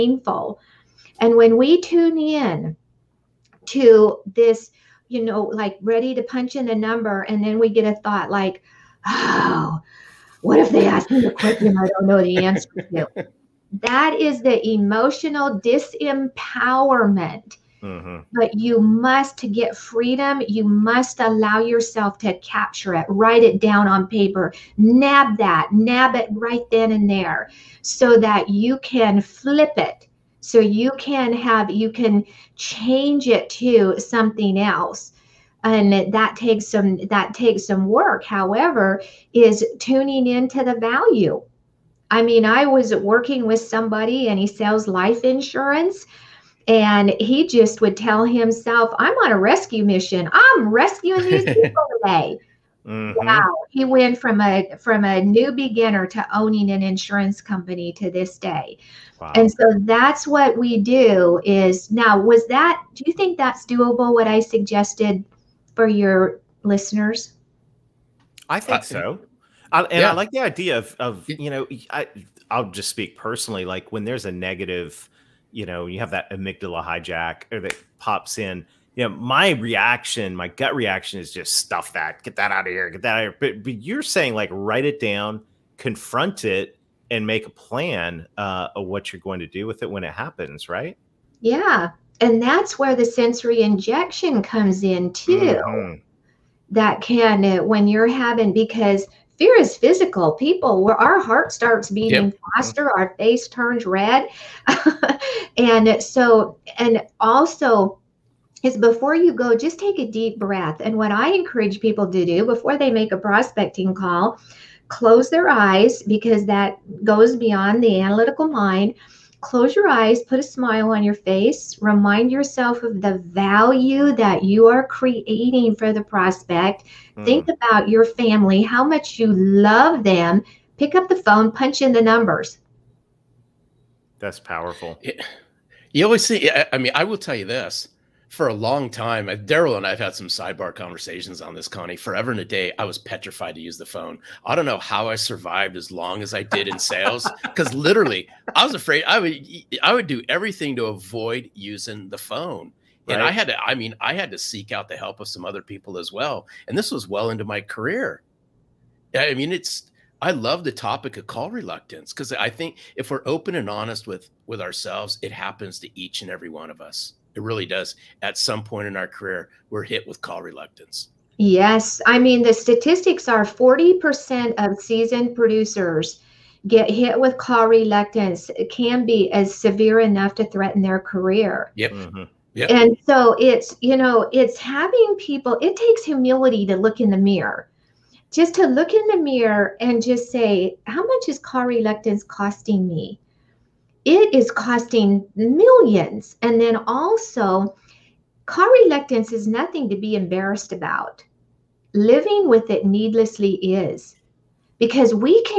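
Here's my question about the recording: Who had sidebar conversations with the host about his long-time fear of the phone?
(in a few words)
Darrell.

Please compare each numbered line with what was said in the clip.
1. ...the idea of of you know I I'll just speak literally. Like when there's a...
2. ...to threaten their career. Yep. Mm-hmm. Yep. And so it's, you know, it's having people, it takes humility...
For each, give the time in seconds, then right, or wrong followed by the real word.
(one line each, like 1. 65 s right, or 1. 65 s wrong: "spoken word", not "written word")
1. 70 s wrong: "personally", not "literally"
2. 180 s right.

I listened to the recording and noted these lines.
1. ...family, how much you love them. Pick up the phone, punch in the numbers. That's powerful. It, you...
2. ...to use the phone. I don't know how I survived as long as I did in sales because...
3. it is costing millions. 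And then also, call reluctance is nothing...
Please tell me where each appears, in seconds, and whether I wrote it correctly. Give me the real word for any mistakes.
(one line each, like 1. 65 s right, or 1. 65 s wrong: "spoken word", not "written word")
1. 128 s right
2. 143 s right
3. 194 s right.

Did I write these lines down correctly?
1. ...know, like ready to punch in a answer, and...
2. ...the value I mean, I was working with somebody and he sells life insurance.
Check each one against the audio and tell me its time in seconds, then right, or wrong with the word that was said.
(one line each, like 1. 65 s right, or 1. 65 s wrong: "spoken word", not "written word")
1. 5 s wrong: "number", not "answer"
2. 40 s right.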